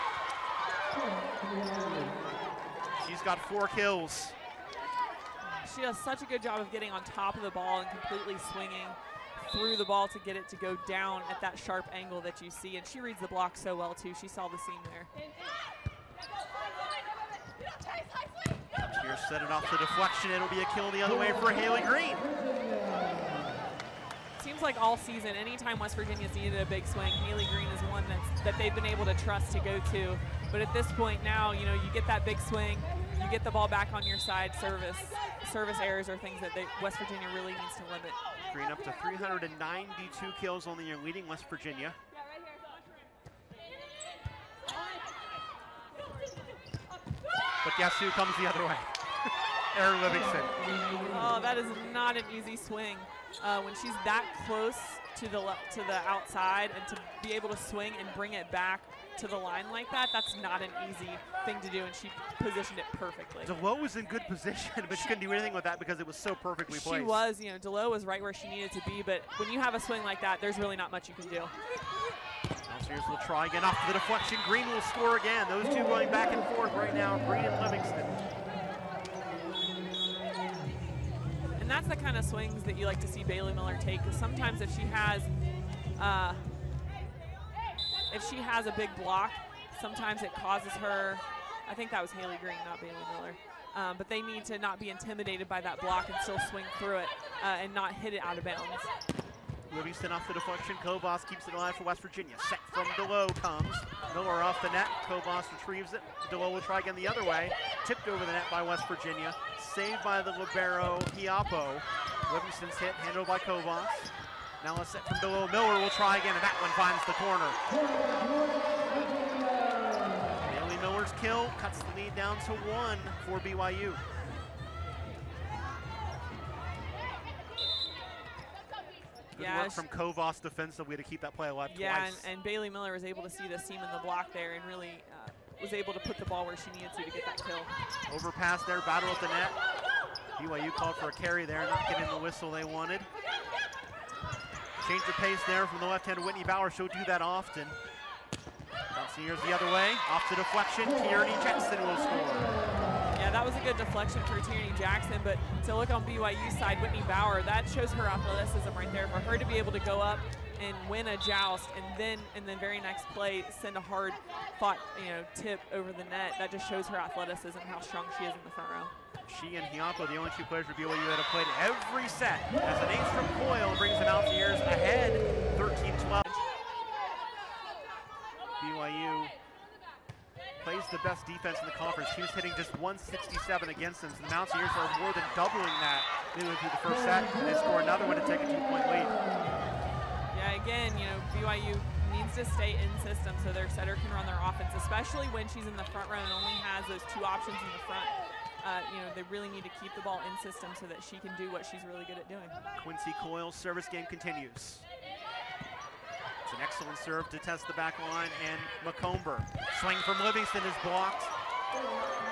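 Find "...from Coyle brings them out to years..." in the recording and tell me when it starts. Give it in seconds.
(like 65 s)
173 s.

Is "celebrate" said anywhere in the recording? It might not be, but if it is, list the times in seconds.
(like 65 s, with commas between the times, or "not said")
not said.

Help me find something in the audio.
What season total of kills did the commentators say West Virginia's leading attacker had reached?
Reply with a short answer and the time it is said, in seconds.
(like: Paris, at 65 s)
392, at 39 s.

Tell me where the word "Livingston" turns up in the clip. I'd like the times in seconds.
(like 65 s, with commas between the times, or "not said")
50 s, 77 s, 99 s, 112 s, 210 s.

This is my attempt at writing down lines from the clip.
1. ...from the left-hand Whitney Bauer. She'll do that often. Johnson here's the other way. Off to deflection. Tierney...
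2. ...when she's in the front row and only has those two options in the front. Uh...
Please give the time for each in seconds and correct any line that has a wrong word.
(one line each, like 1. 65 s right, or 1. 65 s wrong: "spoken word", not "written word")
1. 145 s right
2. 195 s right.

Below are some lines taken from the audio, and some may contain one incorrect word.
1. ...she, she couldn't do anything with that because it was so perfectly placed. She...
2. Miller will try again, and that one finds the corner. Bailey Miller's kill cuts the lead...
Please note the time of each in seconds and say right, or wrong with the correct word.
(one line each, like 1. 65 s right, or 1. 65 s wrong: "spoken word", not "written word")
1. 64 s right
2. 115 s right.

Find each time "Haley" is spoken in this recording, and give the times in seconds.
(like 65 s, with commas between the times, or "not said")
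21 s, 27 s, 92 s.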